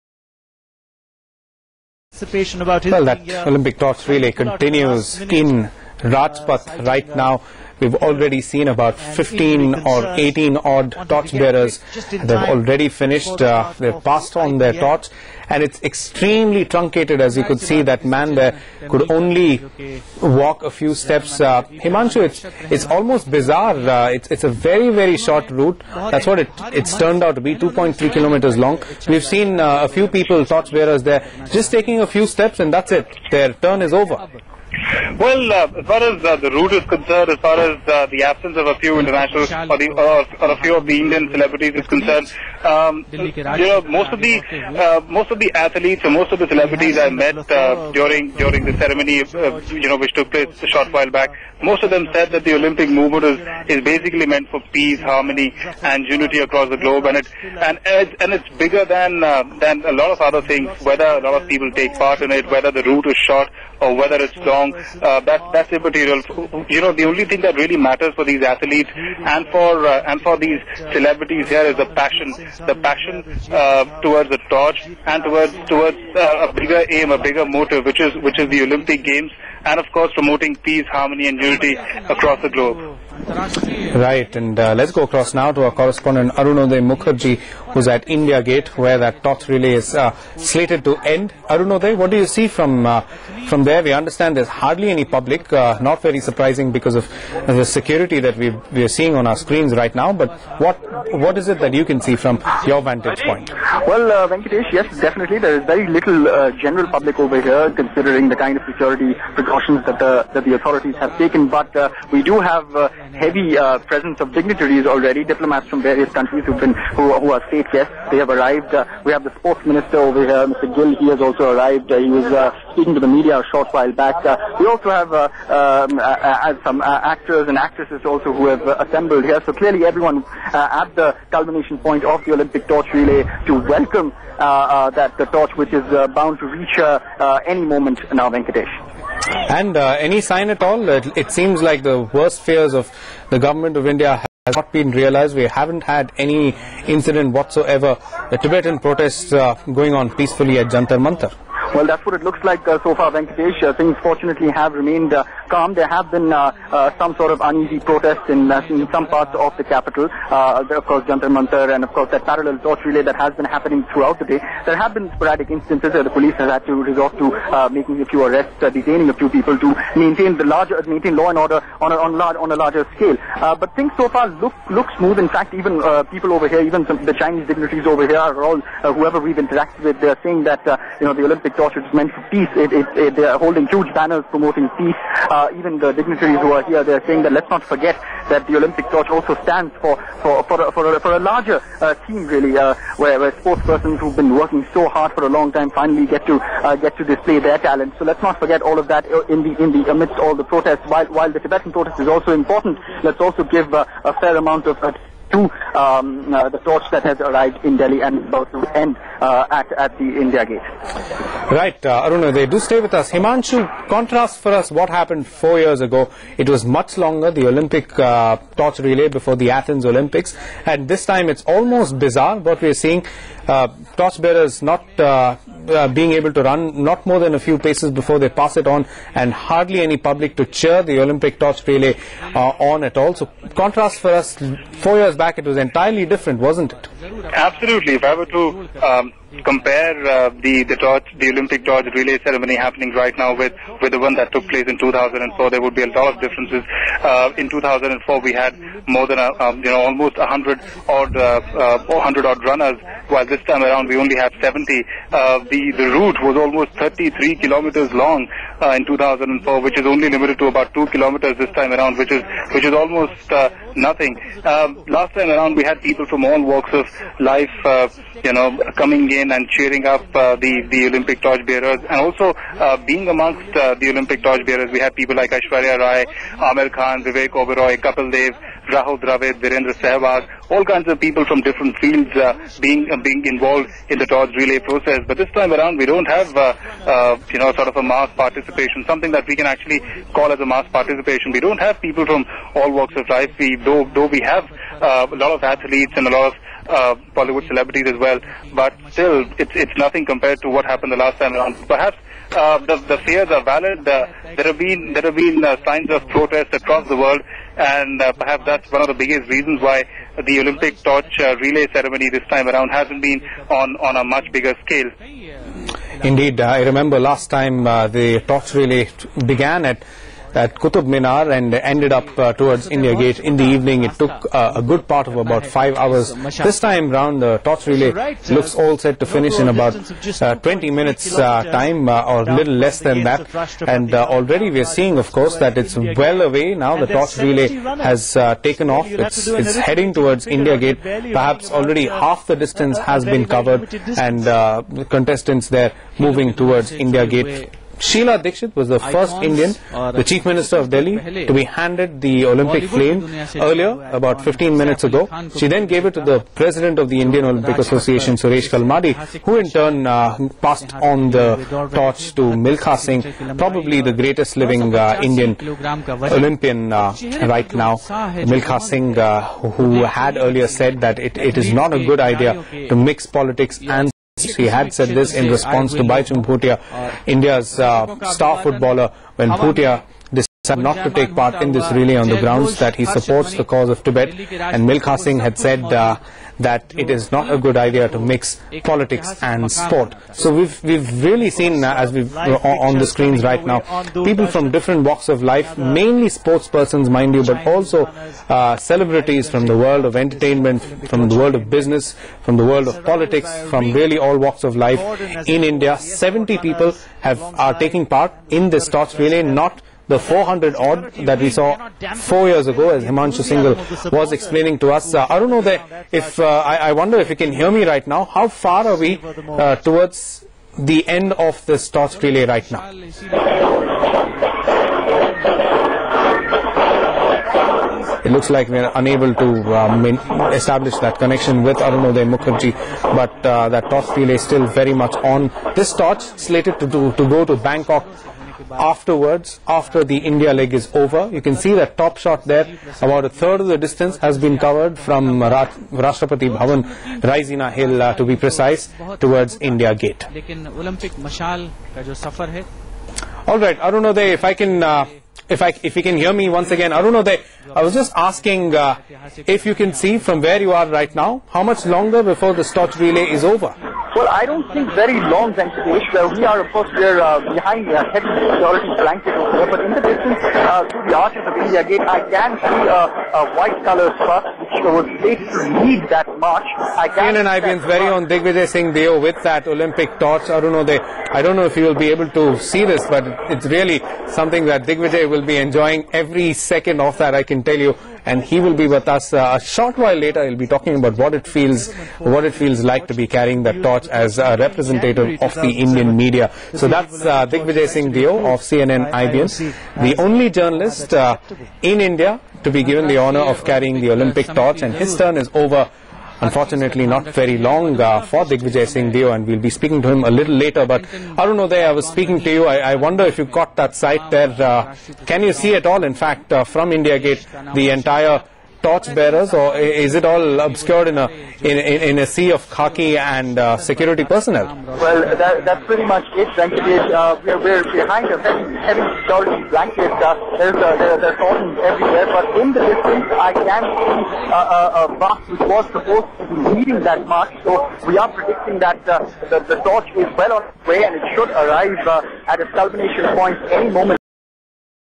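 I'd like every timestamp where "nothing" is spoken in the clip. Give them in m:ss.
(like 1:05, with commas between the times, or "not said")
4:23, 4:59.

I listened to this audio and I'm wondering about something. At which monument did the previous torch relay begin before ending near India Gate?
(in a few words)
Qutub Minar.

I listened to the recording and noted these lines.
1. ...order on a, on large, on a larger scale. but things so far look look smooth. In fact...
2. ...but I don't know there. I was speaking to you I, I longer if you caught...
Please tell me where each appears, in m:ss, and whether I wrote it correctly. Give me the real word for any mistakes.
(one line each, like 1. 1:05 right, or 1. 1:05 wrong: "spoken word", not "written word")
1. 2:51 right
2. 8:30 wrong: "wonder", not "longer".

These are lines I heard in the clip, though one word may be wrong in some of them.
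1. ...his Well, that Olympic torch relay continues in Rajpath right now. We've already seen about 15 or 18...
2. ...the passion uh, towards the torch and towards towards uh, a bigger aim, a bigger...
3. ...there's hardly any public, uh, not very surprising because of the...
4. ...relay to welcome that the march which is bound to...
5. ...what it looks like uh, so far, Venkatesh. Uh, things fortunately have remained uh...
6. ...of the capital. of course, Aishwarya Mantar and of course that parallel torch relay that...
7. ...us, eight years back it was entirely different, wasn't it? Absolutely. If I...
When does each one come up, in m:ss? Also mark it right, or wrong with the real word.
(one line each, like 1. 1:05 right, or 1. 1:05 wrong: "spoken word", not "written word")
1. 0:02 right
2. 1:12 right
3. 1:34 right
4. 2:12 wrong: "torch", not "march"
5. 2:32 right
6. 2:39 wrong: "Jantar", not "Aishwarya"
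7. 3:54 wrong: "four", not "eight".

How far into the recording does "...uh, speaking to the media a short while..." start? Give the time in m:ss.
2:02.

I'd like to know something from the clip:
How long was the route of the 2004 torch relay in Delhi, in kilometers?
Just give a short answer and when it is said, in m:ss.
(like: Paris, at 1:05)
33 kilometers, at 4:16.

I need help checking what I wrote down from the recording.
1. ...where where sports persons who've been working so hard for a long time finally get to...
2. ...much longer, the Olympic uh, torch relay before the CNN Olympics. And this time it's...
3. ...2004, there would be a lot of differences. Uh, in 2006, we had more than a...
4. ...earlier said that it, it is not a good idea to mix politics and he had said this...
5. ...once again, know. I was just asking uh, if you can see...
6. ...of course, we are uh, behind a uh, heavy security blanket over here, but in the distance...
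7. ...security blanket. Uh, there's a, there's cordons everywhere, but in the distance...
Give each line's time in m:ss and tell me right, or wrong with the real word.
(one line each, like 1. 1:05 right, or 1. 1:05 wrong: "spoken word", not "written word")
1. 3:12 right
2. 3:36 wrong: "Athens", not "CNN"
3. 4:04 wrong: "2004", not "2006"
4. 6:10 right
5. 7:36 right
6. 7:46 right
7. 8:49 right.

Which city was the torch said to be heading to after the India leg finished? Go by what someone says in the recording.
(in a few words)
Bangkok.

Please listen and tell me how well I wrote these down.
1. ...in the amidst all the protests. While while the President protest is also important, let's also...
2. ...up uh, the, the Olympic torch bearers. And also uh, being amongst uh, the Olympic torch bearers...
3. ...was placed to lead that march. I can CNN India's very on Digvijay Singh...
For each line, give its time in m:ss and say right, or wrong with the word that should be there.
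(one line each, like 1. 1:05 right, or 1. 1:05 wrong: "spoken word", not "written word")
1. 3:19 wrong: "Tibetan", not "President"
2. 4:29 right
3. 7:54 wrong: "IBN", not "India".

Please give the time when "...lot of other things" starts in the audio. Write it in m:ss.
0:59.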